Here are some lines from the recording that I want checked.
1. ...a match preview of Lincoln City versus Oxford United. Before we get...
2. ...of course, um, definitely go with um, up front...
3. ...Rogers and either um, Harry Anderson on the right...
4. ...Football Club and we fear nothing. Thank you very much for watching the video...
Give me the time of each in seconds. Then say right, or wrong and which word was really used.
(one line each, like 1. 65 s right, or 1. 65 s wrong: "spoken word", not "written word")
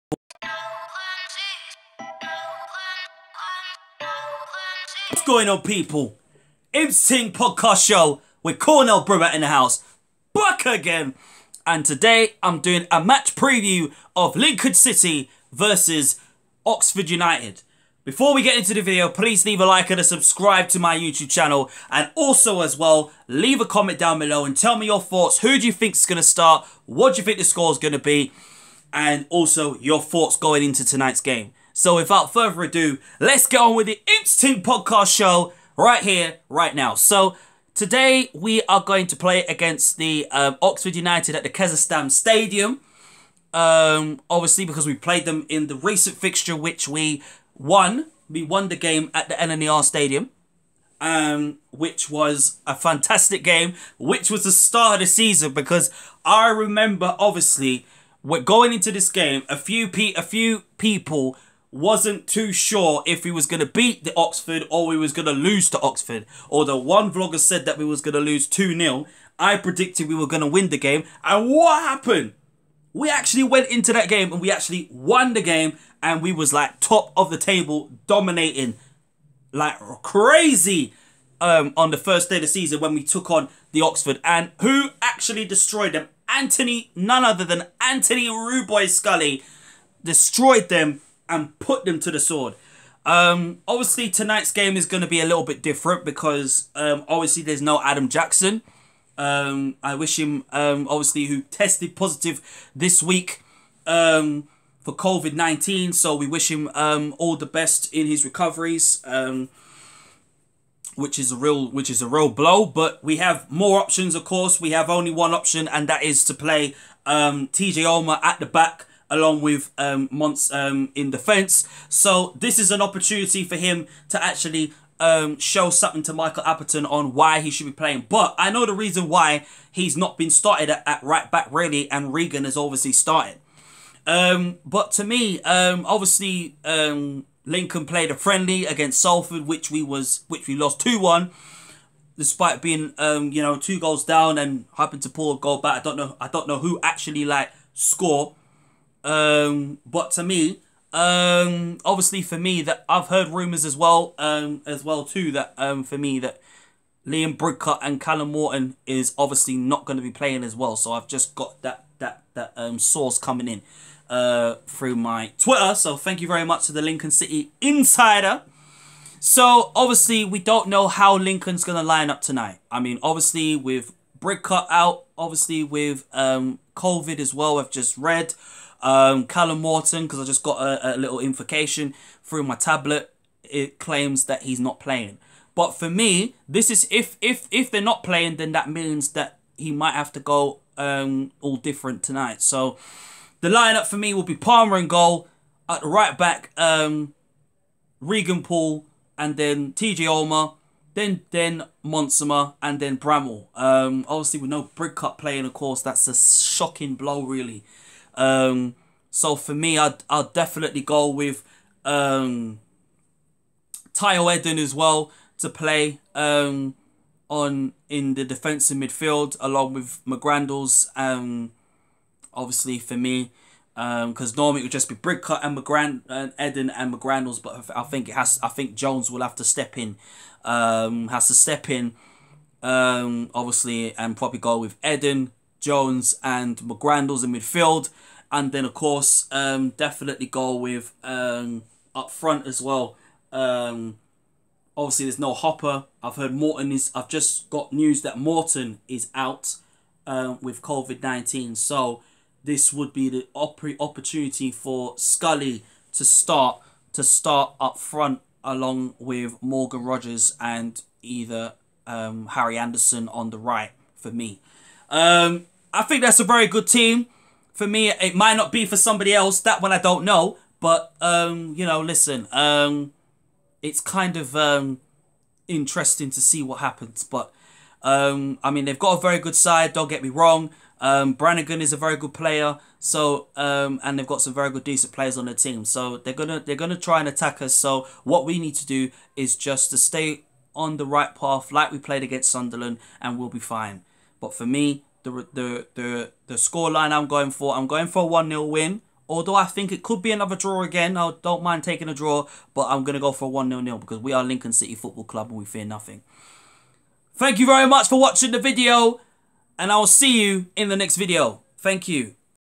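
1. 12 s right
2. 238 s right
3. 259 s right
4. 304 s right.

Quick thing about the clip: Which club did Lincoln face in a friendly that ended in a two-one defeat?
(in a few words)
Salford.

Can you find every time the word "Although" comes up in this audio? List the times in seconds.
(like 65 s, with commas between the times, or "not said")
66 s, 299 s.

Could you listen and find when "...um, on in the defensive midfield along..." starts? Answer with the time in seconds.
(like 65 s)
216 s.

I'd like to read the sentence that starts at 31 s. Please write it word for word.
So without further ado, let's get on with the Instinct Podcast Show right here, right now.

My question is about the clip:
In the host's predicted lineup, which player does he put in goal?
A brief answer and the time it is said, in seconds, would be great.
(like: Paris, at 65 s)
Palmer, at 194 s.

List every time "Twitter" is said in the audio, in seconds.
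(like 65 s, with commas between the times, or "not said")
165 s.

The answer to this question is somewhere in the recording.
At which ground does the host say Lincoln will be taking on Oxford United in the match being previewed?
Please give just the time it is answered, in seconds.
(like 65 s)
41 s.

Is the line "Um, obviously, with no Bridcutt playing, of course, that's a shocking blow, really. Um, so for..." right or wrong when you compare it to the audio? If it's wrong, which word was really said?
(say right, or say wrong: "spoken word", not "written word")
right.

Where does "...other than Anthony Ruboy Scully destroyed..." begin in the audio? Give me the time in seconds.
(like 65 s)
87 s.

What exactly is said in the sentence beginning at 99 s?
Um, I wish him, um, obviously, who tested positive this week um, for COVID 19.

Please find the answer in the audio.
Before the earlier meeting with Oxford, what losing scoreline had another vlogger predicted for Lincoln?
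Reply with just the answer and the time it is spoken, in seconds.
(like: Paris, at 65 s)
2-0, at 68 s.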